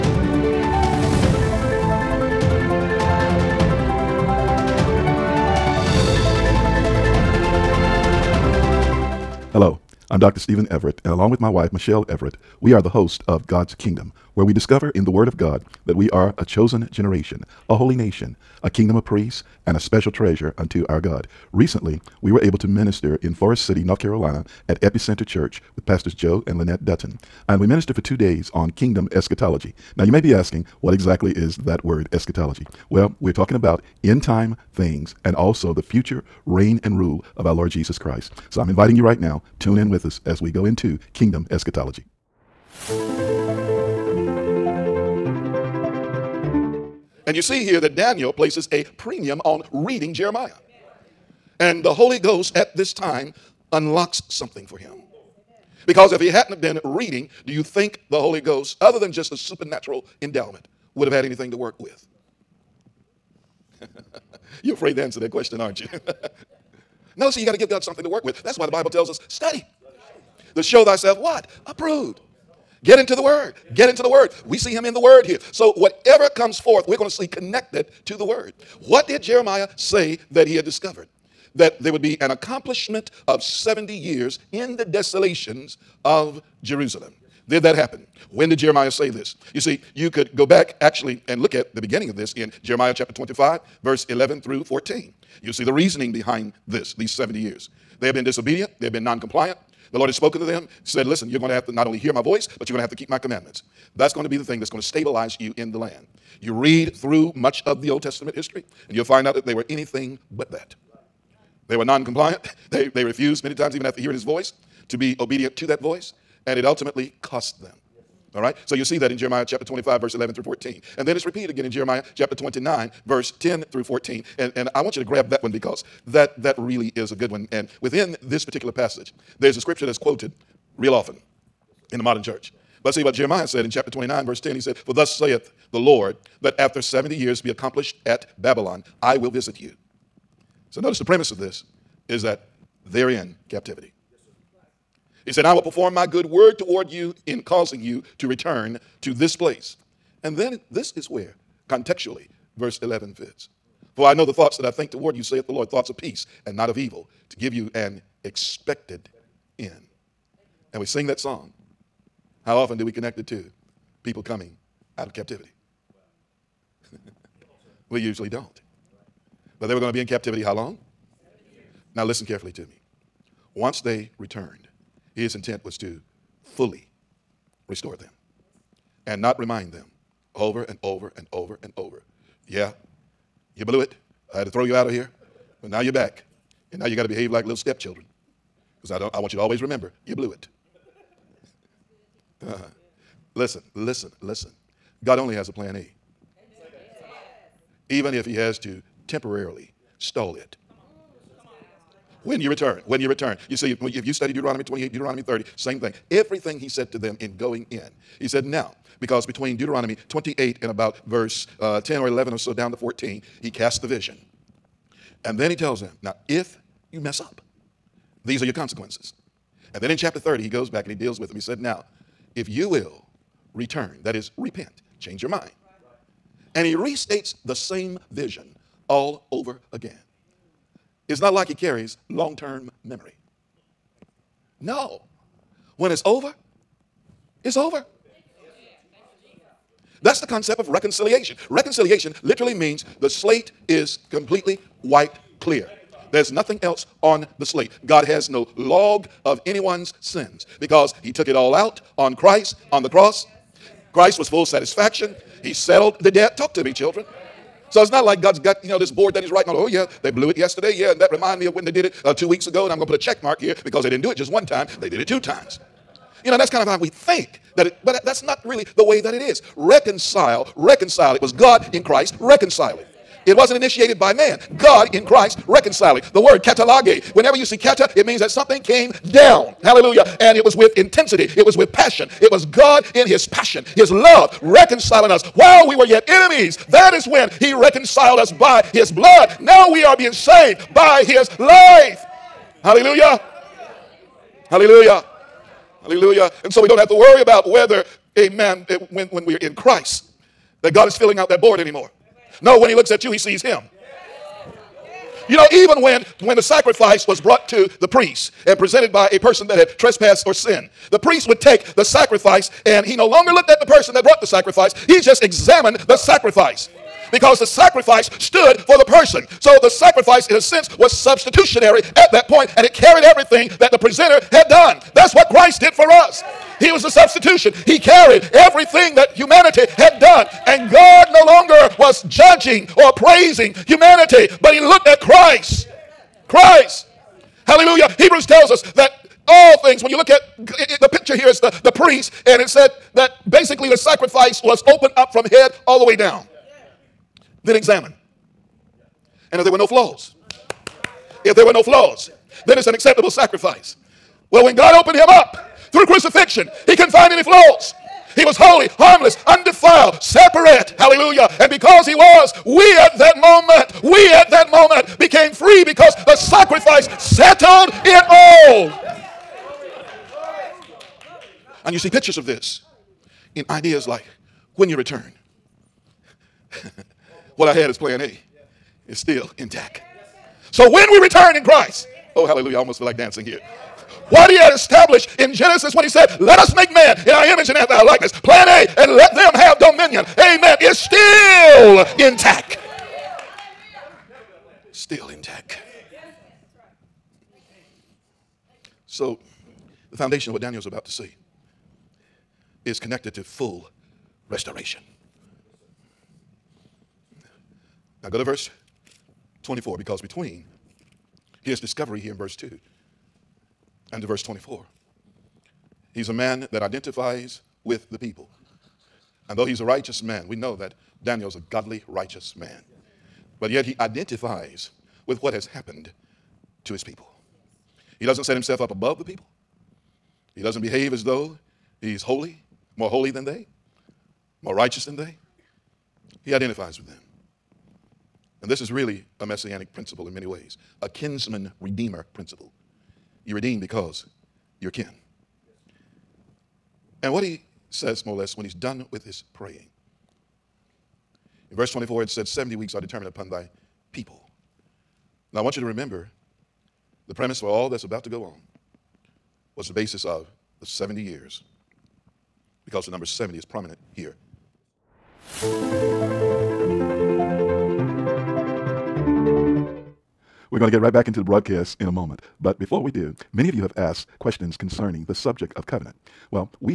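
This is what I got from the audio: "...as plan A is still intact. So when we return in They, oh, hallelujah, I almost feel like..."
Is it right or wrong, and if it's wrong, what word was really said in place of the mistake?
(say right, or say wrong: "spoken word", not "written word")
wrong: "Christ", not "They".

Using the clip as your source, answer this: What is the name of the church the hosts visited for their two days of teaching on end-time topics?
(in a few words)
Epicenter Church.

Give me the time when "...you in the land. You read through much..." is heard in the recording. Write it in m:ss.
1:45.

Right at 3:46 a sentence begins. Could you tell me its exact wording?
And he restates the same vision all over again.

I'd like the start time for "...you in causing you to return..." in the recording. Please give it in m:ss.
2:26.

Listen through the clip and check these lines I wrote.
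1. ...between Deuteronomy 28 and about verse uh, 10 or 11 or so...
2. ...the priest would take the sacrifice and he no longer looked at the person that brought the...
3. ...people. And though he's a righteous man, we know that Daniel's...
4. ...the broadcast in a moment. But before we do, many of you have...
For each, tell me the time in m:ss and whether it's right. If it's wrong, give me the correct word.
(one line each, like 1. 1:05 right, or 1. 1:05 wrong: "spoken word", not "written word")
1. 3:29 right
2. 5:10 right
3. 6:57 right
4. 7:51 right.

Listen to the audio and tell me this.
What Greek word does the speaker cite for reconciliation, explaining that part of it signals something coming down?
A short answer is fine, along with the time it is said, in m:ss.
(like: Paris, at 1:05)
katallage, at 4:36.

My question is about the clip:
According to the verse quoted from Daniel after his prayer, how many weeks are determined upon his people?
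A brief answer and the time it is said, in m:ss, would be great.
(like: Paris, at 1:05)
70, at 7:32.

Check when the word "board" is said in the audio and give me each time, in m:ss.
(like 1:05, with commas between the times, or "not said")
4:18, 5:01.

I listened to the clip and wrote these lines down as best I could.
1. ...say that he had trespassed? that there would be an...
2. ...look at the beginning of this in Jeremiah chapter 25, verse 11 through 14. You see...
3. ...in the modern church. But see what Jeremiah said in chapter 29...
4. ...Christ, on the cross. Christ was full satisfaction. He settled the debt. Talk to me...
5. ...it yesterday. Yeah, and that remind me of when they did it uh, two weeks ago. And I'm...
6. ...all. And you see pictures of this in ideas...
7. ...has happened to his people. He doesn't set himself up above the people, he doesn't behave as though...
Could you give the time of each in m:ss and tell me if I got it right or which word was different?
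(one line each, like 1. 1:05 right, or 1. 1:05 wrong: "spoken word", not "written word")
1. 1:19 wrong: "discovered", not "trespassed"
2. 1:31 right
3. 2:11 right
4. 4:12 right
5. 4:20 right
6. 6:08 right
7. 7:05 right.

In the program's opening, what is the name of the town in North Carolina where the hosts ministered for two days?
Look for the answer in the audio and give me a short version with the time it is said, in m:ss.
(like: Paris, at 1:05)
Forest City, at 0:23.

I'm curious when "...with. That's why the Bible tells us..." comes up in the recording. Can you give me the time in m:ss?
1:08.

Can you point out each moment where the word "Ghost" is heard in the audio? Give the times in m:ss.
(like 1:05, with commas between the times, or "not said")
0:52, 0:58.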